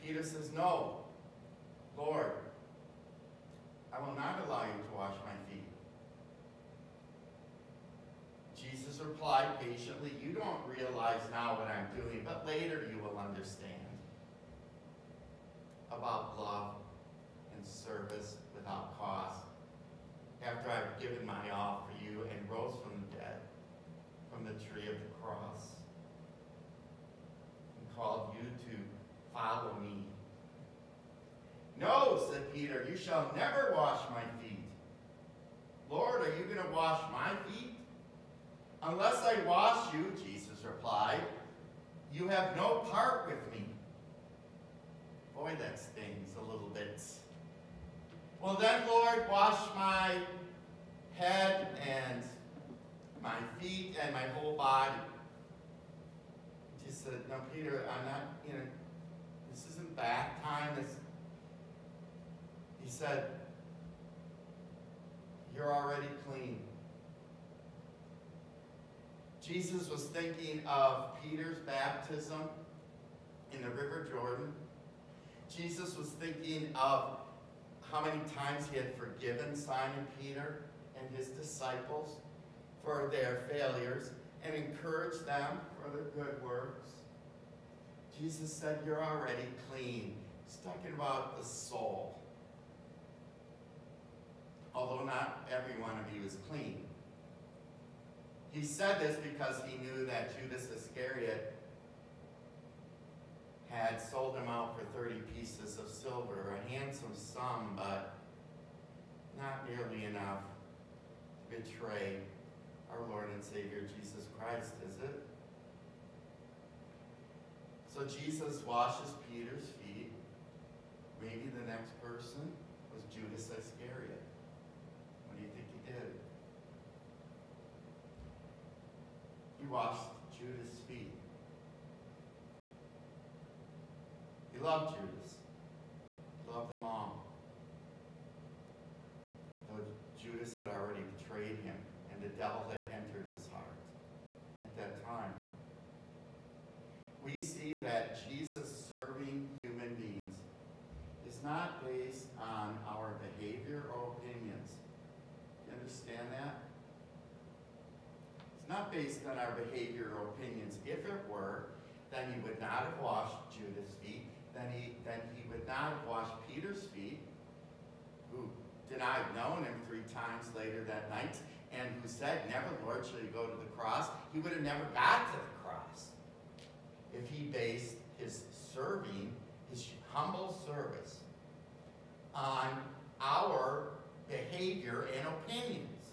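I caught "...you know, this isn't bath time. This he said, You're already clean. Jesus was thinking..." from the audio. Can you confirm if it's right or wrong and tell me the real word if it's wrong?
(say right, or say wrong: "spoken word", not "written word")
right.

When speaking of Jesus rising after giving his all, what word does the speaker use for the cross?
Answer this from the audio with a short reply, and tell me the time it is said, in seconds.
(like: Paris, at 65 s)
Tree, at 24 s.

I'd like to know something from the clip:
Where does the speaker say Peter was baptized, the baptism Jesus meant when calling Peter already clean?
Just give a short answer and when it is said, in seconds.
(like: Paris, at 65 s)
River Jordan, at 73 s.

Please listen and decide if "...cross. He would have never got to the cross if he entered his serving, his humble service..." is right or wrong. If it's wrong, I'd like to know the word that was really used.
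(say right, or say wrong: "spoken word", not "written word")
wrong: "based", not "entered".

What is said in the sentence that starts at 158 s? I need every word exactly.
It's not based on our behavior or opinions.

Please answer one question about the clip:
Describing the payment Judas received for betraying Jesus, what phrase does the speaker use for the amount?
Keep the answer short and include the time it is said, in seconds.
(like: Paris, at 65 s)
A handsome sum, at 106 s.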